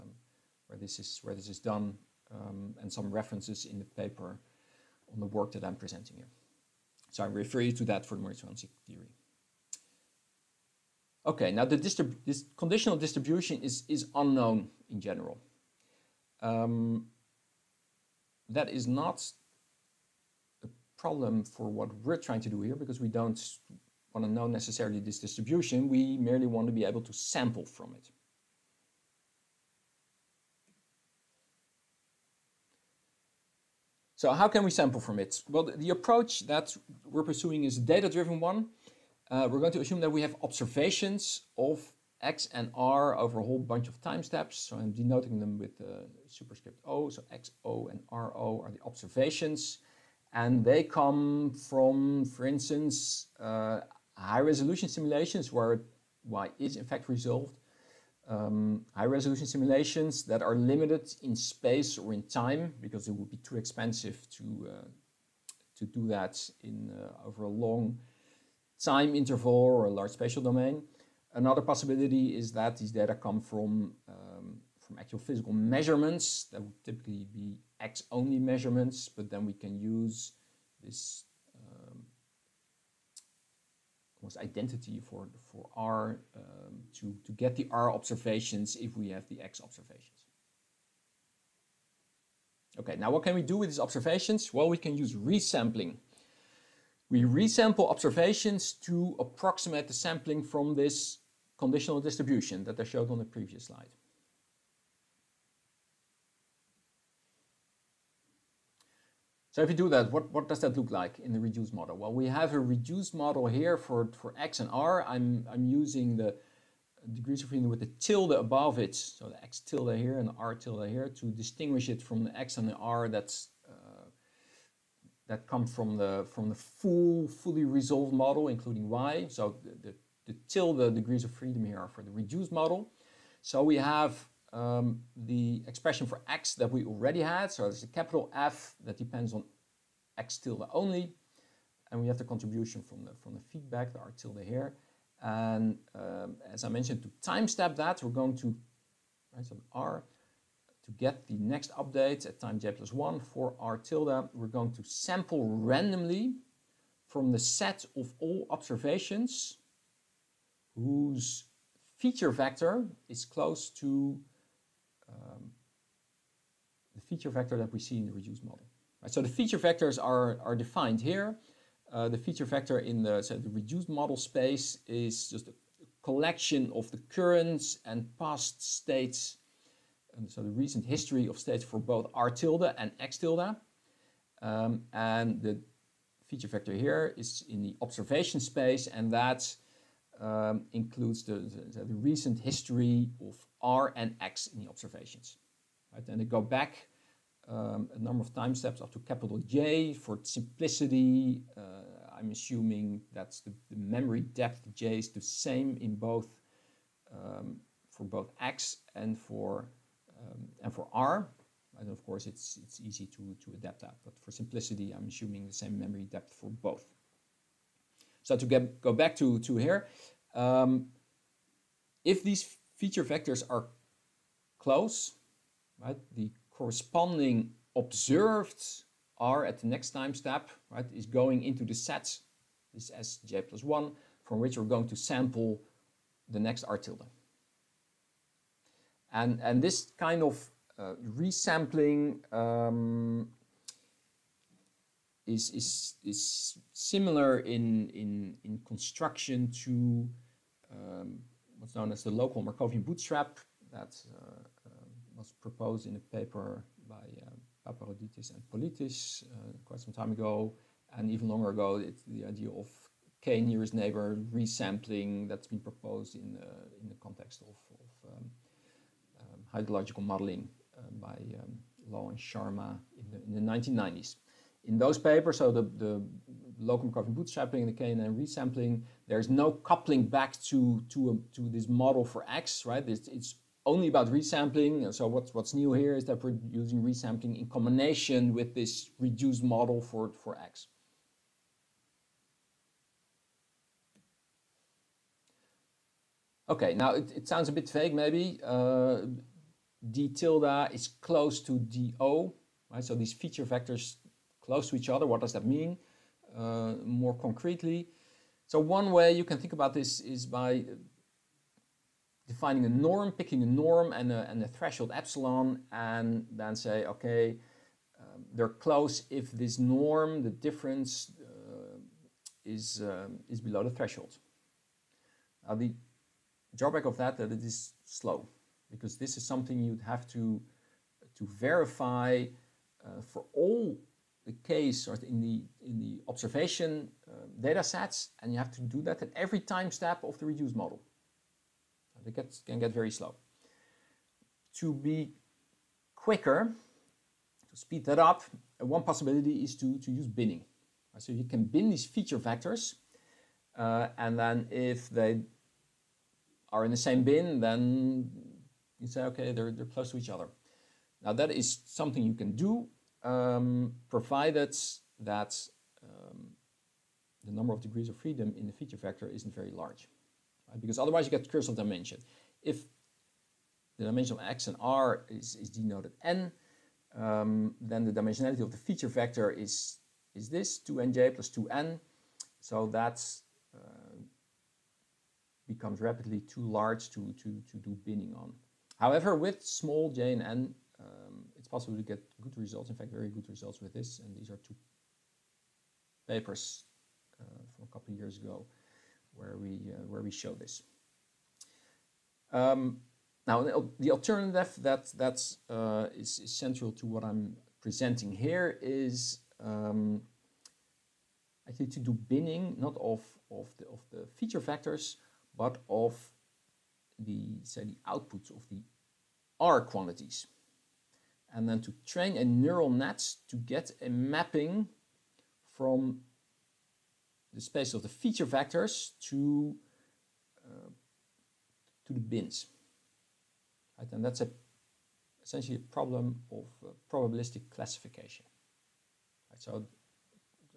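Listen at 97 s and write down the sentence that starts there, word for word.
We resample observations to approximate the sampling from this conditional distribution that I showed on the previous slide.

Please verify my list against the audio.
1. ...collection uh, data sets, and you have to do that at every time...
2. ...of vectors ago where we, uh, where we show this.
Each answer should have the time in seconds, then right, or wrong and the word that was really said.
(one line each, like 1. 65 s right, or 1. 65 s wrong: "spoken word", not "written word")
1. 336 s wrong: "observation", not "collection"
2. 397 s wrong: "years", not "vectors".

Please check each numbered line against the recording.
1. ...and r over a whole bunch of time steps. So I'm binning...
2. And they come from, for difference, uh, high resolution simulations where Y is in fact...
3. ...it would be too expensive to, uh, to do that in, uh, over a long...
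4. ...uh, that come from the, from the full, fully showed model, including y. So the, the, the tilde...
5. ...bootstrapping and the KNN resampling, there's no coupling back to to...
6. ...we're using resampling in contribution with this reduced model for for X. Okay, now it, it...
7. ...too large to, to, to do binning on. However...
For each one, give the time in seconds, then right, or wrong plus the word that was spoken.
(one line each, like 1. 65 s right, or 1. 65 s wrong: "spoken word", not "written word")
1. 42 s wrong: "denoting", not "binning"
2. 50 s wrong: "instance", not "difference"
3. 63 s right
4. 123 s wrong: "resolved", not "showed"
5. 277 s right
6. 286 s wrong: "combination", not "contribution"
7. 386 s right.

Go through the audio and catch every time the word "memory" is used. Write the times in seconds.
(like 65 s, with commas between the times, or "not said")
203 s, 215 s.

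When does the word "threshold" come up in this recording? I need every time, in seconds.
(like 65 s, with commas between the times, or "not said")
314 s, 323 s.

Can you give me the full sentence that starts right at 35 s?
Well, the approach that we're pursuing is a data-driven one.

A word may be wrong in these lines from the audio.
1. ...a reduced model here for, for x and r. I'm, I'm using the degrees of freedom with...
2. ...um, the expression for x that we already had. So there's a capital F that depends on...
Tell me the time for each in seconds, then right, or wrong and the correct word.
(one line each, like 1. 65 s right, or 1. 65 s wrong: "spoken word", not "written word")
1. 112 s right
2. 134 s right.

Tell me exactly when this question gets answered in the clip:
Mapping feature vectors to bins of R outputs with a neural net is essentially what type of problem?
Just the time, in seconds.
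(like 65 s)
436 s.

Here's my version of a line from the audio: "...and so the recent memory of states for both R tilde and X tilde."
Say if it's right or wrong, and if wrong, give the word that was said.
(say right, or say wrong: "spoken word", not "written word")
wrong: "history", not "memory".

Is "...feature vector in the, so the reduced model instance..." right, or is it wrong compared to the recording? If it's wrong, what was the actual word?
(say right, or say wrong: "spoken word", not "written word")
wrong: "space", not "instance".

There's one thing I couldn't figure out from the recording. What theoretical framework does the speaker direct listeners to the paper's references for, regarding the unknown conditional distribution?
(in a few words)
Mori-Zwanzig theory.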